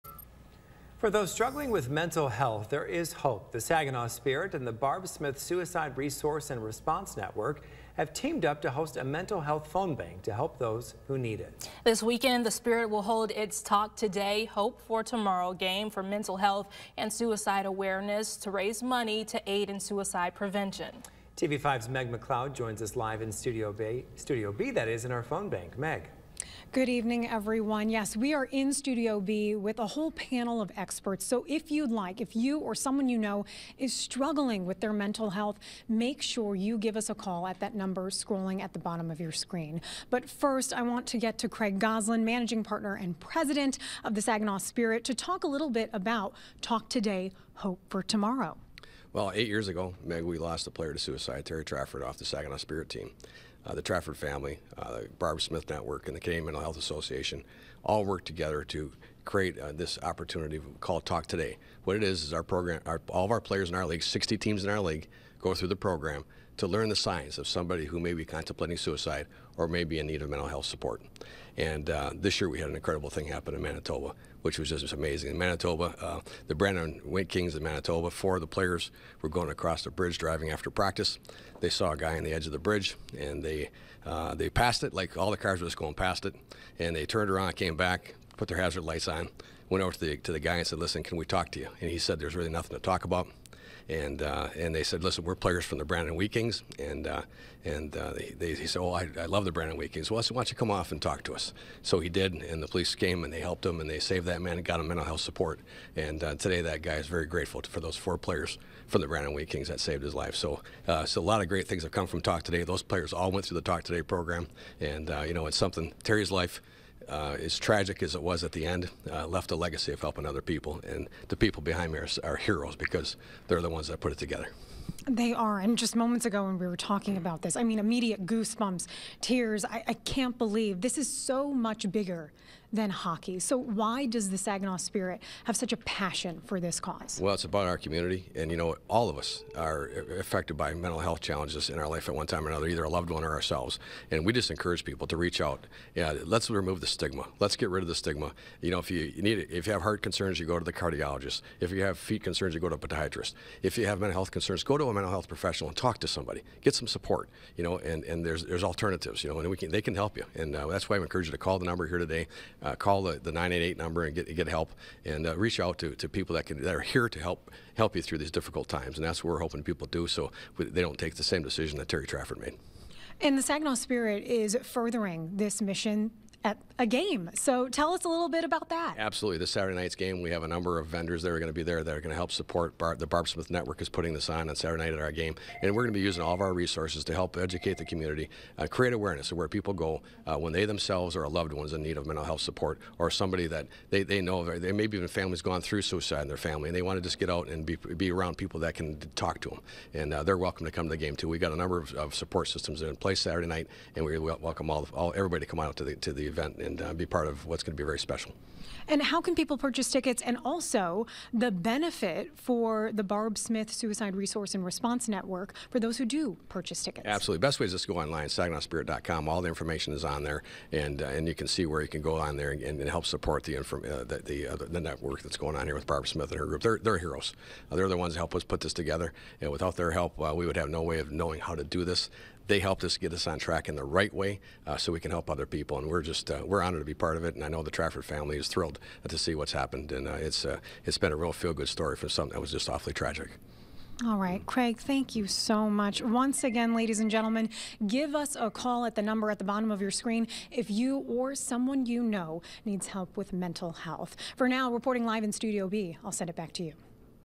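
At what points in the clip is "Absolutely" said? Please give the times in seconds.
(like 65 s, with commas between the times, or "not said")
178 s, 217 s.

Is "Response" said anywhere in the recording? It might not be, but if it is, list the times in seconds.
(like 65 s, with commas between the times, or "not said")
6 s, 214 s.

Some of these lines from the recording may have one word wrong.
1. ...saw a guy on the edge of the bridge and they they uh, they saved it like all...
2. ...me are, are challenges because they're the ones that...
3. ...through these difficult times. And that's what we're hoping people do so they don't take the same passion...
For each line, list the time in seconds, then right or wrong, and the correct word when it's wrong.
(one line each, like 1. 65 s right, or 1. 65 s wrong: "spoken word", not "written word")
1. 81 s wrong: "passed", not "saved"
2. 121 s wrong: "heroes", not "challenges"
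3. 168 s wrong: "decision", not "passion".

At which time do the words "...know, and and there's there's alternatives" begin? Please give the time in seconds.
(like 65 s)
157 s.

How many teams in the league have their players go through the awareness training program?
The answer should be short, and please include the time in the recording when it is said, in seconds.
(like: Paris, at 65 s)
60, at 64 s.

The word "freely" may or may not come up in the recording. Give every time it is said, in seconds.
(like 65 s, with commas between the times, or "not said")
not said.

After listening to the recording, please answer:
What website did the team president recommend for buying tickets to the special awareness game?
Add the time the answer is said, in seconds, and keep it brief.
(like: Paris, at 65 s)
SaginawSpirit.com, at 218 s.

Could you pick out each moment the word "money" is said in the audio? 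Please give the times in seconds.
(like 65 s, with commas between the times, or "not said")
18 s.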